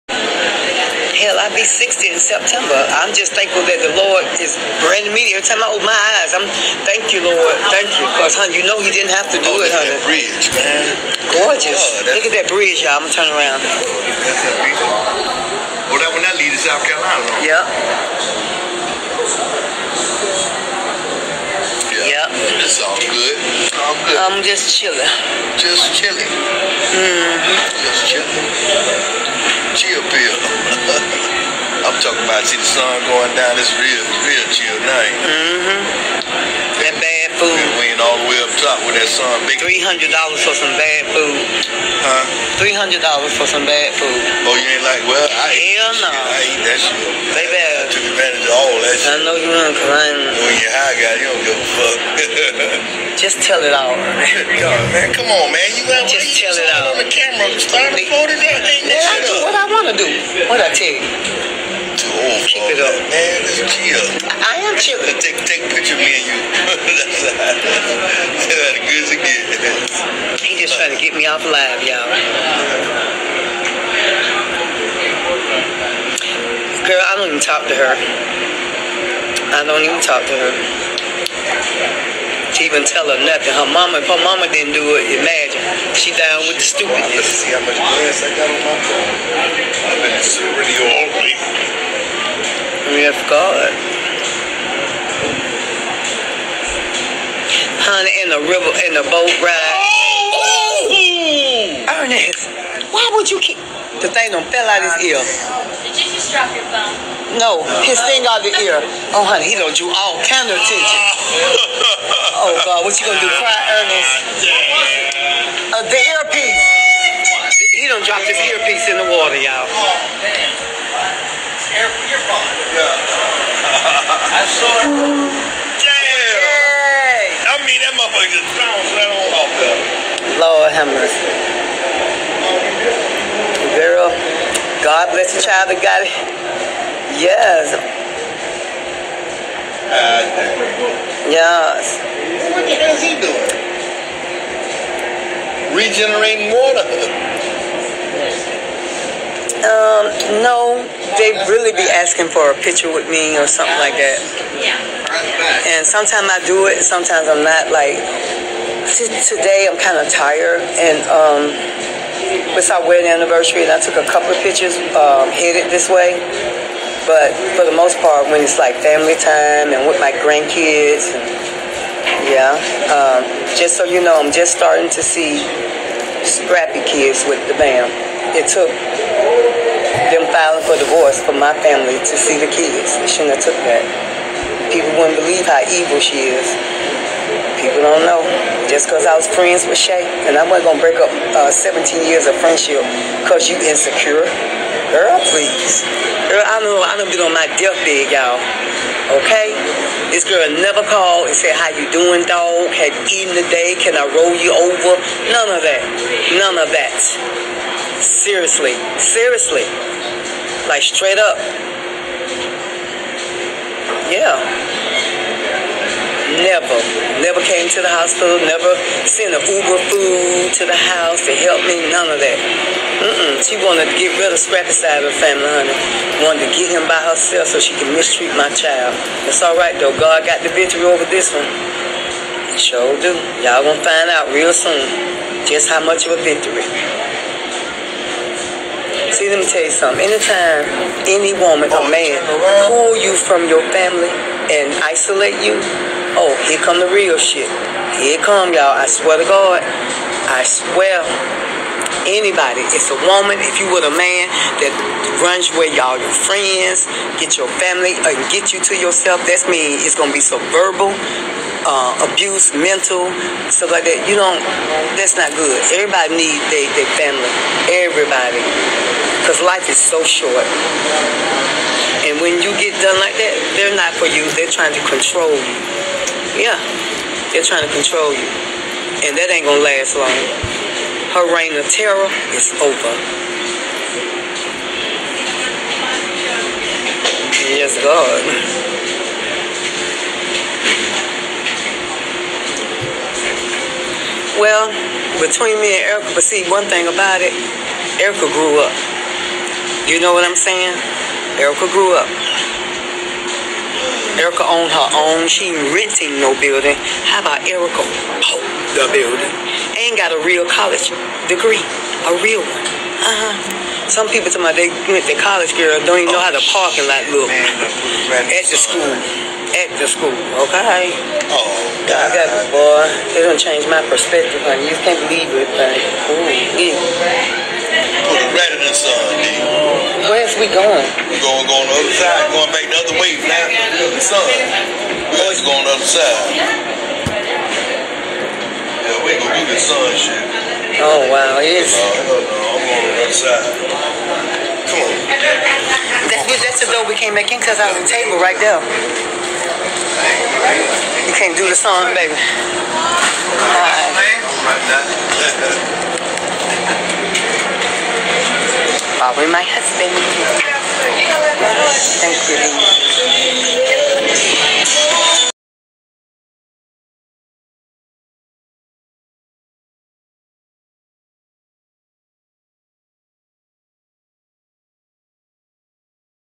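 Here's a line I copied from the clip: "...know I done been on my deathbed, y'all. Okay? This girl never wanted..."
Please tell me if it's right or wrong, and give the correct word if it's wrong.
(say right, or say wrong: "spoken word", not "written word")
wrong: "called", not "wanted".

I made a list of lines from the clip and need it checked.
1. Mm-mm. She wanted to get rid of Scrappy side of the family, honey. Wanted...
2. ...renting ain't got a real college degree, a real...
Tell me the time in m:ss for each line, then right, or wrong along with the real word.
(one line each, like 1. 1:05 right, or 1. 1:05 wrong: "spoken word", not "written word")
1. 3:43 right
2. 5:08 wrong: "building", not "renting".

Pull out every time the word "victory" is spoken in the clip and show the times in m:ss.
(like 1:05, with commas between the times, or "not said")
3:50, 3:56.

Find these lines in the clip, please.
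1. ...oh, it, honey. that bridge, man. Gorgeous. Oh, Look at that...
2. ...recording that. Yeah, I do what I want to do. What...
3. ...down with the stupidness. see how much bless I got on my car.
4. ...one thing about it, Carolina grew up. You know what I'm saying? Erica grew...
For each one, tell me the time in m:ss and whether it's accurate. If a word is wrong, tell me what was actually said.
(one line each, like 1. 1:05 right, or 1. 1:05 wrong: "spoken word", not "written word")
1. 0:09 right
2. 0:57 right
3. 1:26 wrong: "glass", not "bless"
4. 4:56 wrong: "Erica", not "Carolina".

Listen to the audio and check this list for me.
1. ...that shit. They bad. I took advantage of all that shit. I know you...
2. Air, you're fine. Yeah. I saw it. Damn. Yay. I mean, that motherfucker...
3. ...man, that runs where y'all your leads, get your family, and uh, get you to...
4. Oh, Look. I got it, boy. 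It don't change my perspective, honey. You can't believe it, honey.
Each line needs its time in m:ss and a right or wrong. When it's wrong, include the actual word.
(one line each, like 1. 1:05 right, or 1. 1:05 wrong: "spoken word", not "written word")
1. 0:46 right
2. 2:01 right
3. 4:13 wrong: "friends", not "leads"
4. 5:21 wrong: "God", not "Look".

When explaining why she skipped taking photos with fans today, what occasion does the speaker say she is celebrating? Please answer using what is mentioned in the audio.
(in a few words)
Wedding anniversary.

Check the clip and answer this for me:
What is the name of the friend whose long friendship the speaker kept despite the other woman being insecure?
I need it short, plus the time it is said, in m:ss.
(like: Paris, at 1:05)
Shay, at 3:09.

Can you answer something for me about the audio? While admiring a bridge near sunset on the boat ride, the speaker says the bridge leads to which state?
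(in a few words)
South Carolina.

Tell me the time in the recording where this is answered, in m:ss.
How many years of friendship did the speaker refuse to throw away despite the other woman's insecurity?
3:11.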